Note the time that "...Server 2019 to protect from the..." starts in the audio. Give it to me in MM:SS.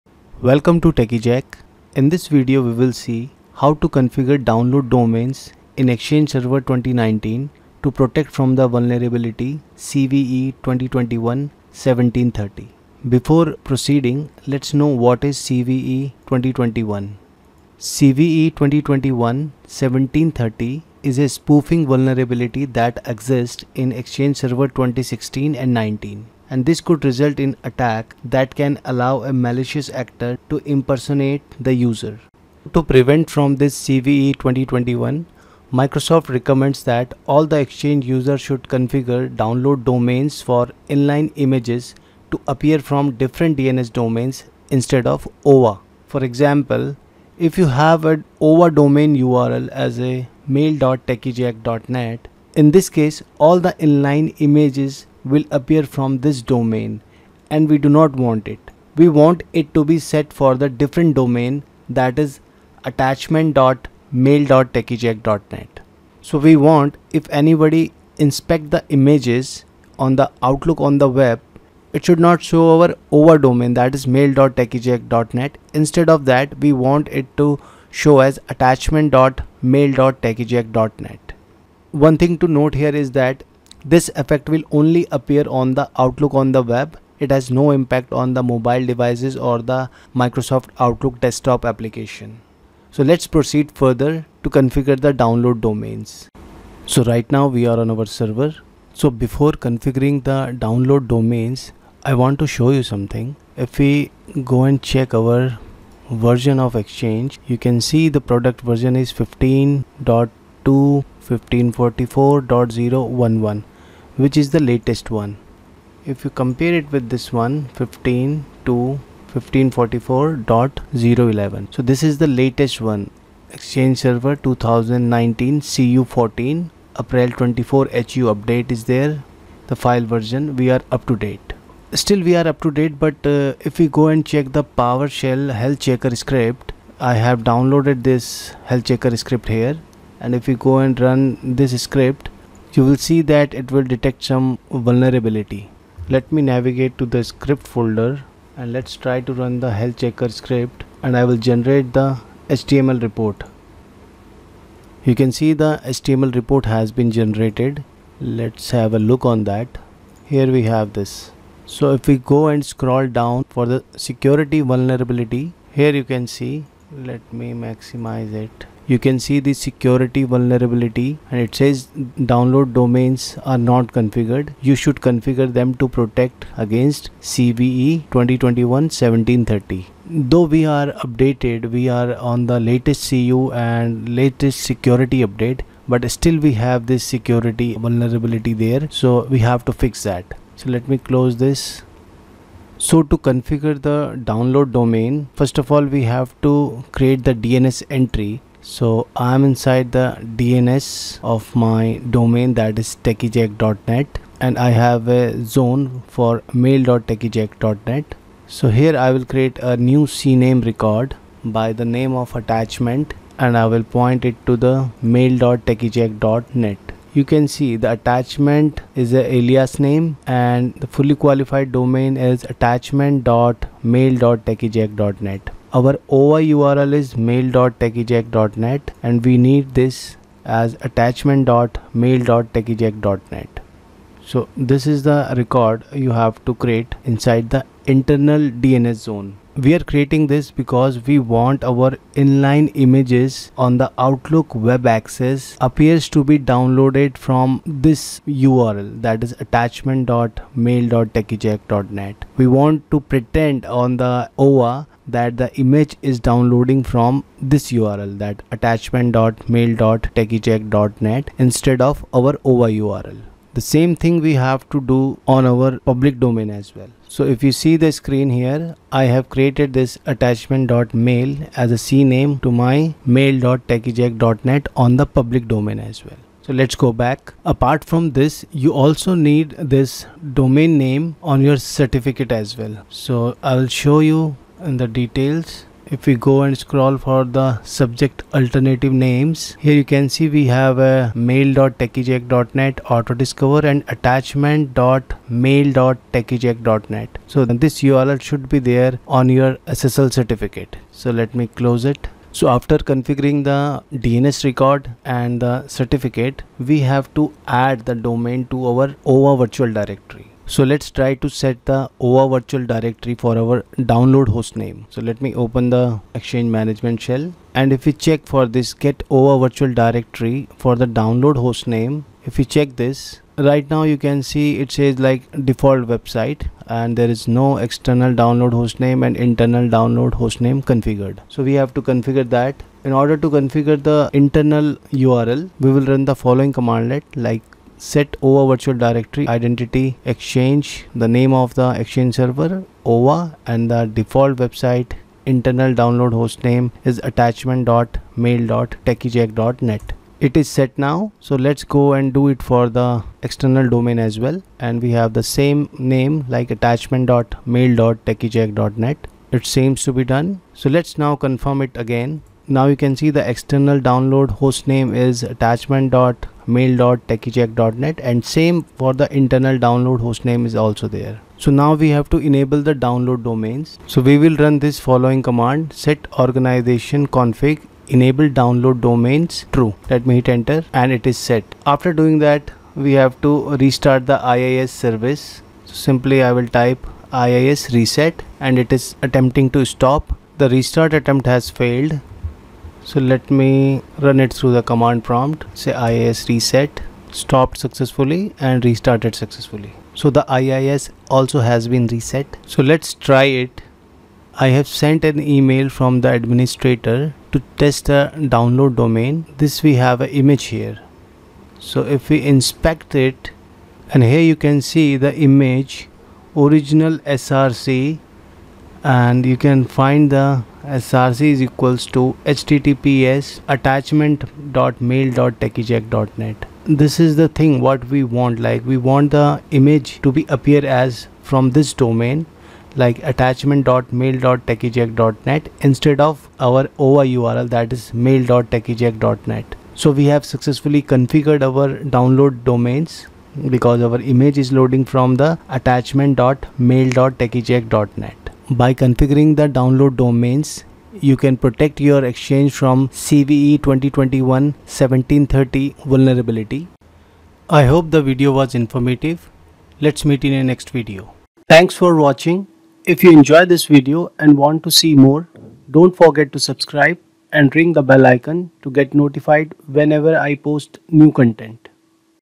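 00:06.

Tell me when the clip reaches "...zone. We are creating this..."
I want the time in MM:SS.
03:58.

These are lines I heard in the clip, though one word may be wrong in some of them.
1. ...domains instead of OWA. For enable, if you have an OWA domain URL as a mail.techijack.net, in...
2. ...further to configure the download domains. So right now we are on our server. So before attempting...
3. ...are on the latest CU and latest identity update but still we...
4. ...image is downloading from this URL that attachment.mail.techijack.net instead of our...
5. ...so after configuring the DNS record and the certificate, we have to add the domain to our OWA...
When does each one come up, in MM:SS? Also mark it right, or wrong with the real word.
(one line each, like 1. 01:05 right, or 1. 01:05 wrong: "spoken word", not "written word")
1. 00:43 wrong: "example", not "enable"
2. 01:33 wrong: "configuring", not "attempting"
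3. 03:01 wrong: "security", not "identity"
4. 04:15 right
5. 05:02 right.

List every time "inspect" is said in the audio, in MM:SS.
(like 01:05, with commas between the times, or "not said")
01:08, 06:52.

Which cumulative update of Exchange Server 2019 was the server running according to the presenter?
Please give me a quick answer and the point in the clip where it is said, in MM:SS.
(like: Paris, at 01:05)
CU14, at 02:05.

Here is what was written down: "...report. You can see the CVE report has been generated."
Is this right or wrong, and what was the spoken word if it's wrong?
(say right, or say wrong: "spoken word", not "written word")
wrong: "HTML", not "CVE".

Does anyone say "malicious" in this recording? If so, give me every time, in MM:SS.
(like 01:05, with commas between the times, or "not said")
00:29.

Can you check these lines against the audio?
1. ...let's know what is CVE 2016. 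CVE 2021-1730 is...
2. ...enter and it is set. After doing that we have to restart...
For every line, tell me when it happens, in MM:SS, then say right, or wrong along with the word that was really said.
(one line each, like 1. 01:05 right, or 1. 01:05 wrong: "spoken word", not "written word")
1. 00:14 wrong: "2021", not "2016"
2. 06:20 right.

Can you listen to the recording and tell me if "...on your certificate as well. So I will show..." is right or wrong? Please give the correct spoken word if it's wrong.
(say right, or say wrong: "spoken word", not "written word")
right.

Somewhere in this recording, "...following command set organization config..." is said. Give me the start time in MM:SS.
06:14.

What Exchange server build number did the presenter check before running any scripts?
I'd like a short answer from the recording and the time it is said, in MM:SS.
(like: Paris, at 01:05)
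15.2 1544.011, at 01:49.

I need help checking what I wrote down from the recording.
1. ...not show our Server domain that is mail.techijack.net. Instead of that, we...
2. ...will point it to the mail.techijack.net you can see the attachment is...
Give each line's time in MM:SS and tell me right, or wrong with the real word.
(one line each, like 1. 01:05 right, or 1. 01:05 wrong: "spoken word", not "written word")
1. 01:12 wrong: "OWA", not "Server"
2. 03:33 right.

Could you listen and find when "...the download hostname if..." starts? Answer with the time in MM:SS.
05:20.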